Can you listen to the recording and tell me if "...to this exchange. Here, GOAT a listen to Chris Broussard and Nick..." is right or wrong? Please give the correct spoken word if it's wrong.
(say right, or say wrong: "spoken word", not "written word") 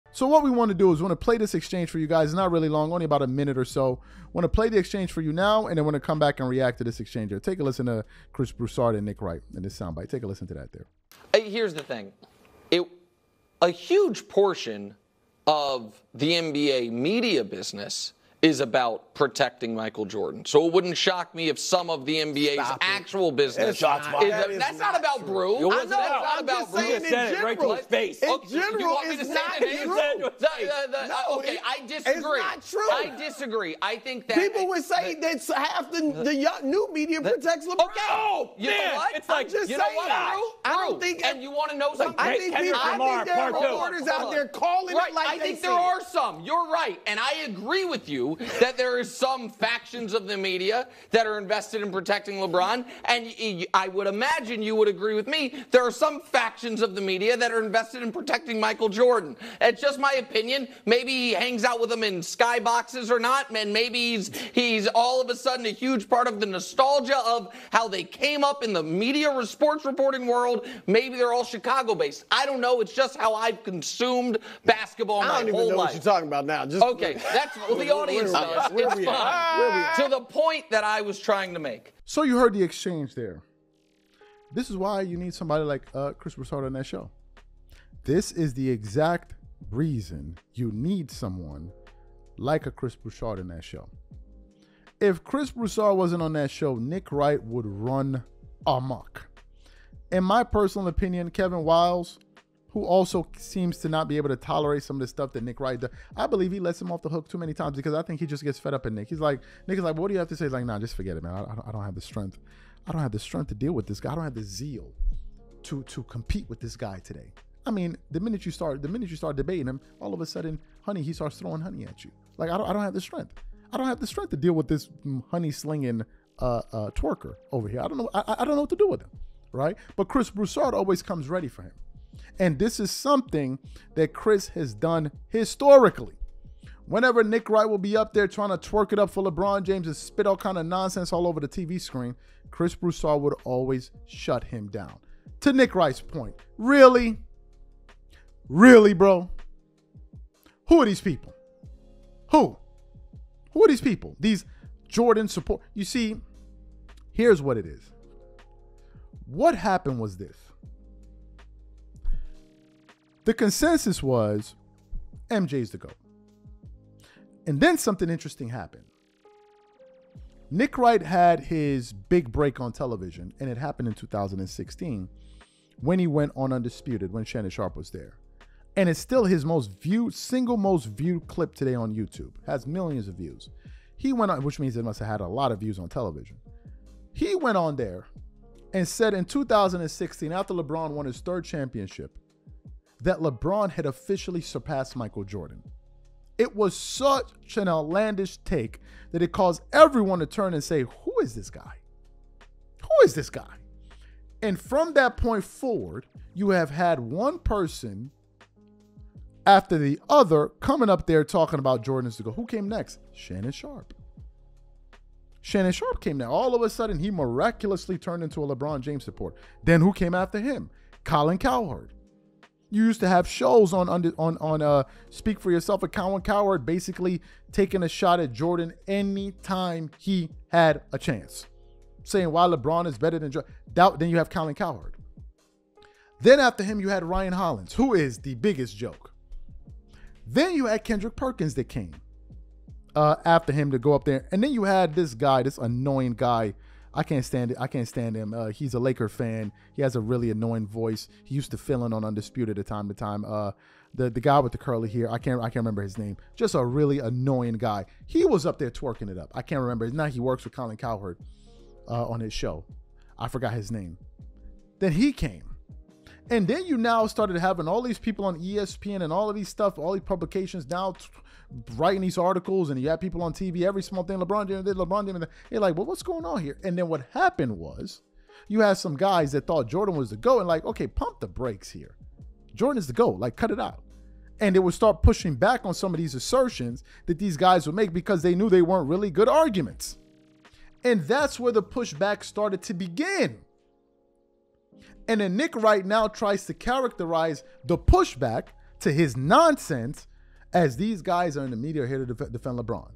wrong: "Take", not "GOAT".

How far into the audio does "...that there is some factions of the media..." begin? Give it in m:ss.
0:48.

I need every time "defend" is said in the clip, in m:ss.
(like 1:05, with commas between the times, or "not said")
5:02.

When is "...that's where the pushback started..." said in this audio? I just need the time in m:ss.
4:51.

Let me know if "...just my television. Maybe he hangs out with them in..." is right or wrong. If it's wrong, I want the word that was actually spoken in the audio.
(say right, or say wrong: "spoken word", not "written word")
wrong: "opinion", not "television".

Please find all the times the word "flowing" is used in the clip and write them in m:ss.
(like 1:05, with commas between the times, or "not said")
not said.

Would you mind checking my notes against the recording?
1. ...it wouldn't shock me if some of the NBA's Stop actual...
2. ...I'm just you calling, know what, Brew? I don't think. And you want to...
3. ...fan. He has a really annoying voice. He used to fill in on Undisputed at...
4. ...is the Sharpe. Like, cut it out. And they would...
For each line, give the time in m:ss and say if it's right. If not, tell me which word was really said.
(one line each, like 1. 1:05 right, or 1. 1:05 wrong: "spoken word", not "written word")
1. 0:20 right
2. 0:39 wrong: "saying", not "calling"
3. 4:09 right
4. 4:42 wrong: "GOAT", not "Sharpe".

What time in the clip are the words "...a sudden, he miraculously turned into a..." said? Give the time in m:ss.
3:36.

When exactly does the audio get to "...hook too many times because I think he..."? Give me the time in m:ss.
1:47.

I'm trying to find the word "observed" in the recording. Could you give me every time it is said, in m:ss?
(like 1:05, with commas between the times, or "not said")
not said.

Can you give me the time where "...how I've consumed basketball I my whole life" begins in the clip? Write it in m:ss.
1:13.